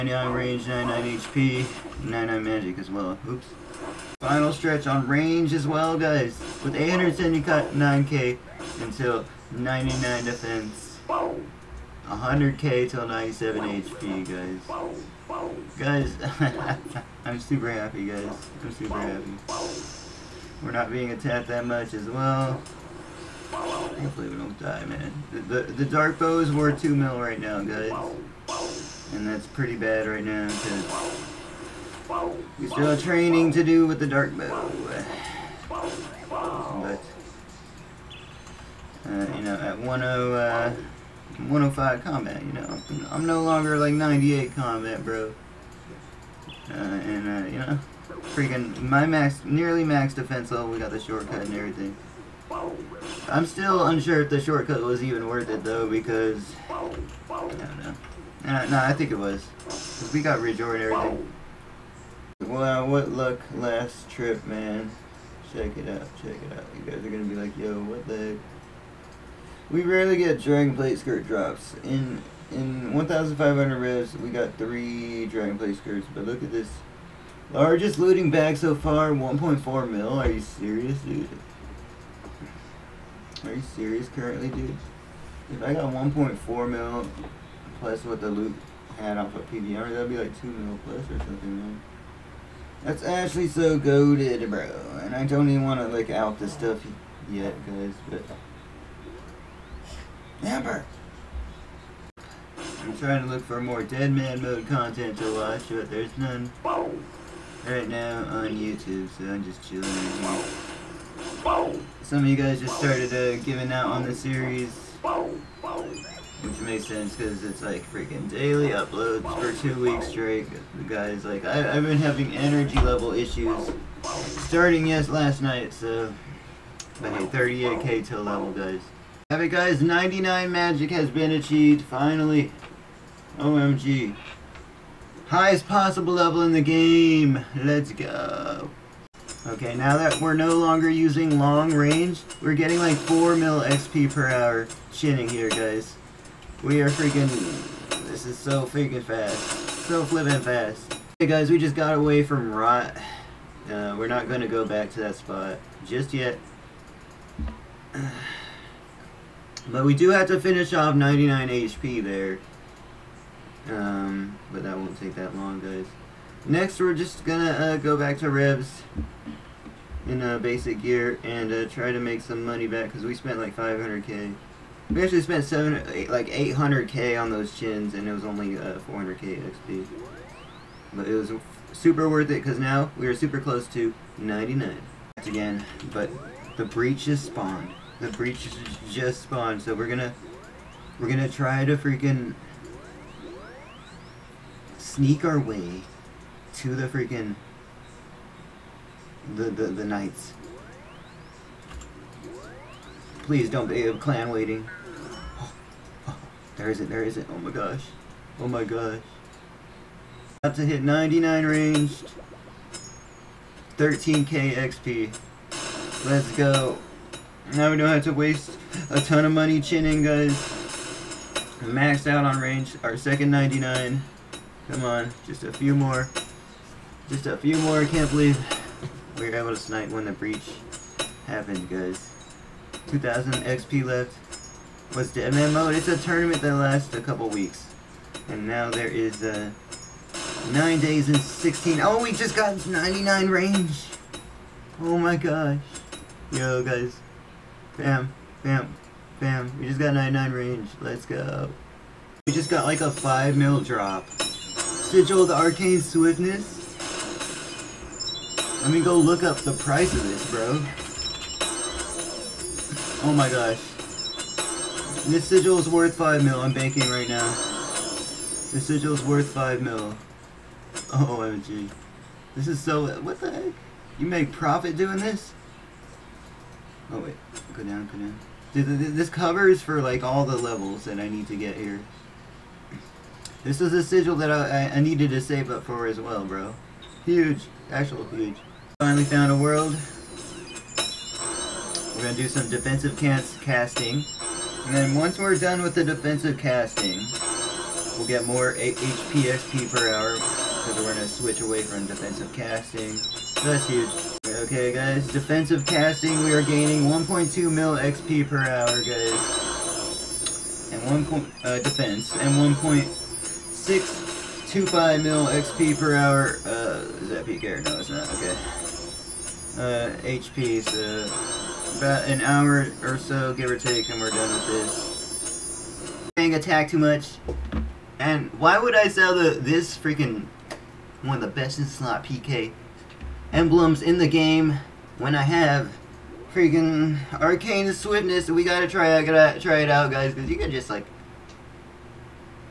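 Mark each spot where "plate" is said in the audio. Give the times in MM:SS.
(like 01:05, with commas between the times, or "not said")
01:10, 01:15.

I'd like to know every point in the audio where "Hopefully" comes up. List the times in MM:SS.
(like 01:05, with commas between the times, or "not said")
00:23.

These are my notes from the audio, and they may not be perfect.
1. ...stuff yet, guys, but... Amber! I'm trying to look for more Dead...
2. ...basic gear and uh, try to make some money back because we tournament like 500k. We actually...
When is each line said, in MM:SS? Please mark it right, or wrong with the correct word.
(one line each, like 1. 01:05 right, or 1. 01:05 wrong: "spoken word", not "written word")
1. 01:36 right
2. 02:50 wrong: "spent", not "tournament".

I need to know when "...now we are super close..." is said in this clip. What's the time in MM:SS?
03:02.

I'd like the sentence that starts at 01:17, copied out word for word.
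Largest looting bag so far, 1.4 mil.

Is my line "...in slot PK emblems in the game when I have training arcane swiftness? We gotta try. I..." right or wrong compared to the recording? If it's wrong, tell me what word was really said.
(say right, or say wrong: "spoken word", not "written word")
wrong: "freaking", not "training".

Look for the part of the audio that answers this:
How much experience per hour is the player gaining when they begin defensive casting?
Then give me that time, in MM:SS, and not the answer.
05:06.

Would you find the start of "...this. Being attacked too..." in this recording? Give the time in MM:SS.
05:24.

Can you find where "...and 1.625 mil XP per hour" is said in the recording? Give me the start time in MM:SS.
05:12.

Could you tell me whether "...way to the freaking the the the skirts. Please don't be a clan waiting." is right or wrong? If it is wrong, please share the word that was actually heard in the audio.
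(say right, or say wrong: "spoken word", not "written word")
wrong: "knights", not "skirts".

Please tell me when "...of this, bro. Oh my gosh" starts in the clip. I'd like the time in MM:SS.
04:19.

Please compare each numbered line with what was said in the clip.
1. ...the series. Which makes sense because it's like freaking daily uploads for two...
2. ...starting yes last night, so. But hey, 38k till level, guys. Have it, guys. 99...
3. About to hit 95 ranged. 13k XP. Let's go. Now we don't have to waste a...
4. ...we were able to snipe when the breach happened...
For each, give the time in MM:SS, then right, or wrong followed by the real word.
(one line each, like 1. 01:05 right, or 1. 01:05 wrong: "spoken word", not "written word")
1. 01:54 right
2. 02:04 right
3. 03:30 wrong: "99", not "95"
4. 03:49 right.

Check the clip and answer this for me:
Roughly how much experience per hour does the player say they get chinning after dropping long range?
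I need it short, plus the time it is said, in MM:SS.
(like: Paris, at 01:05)
4 mil, at 02:22.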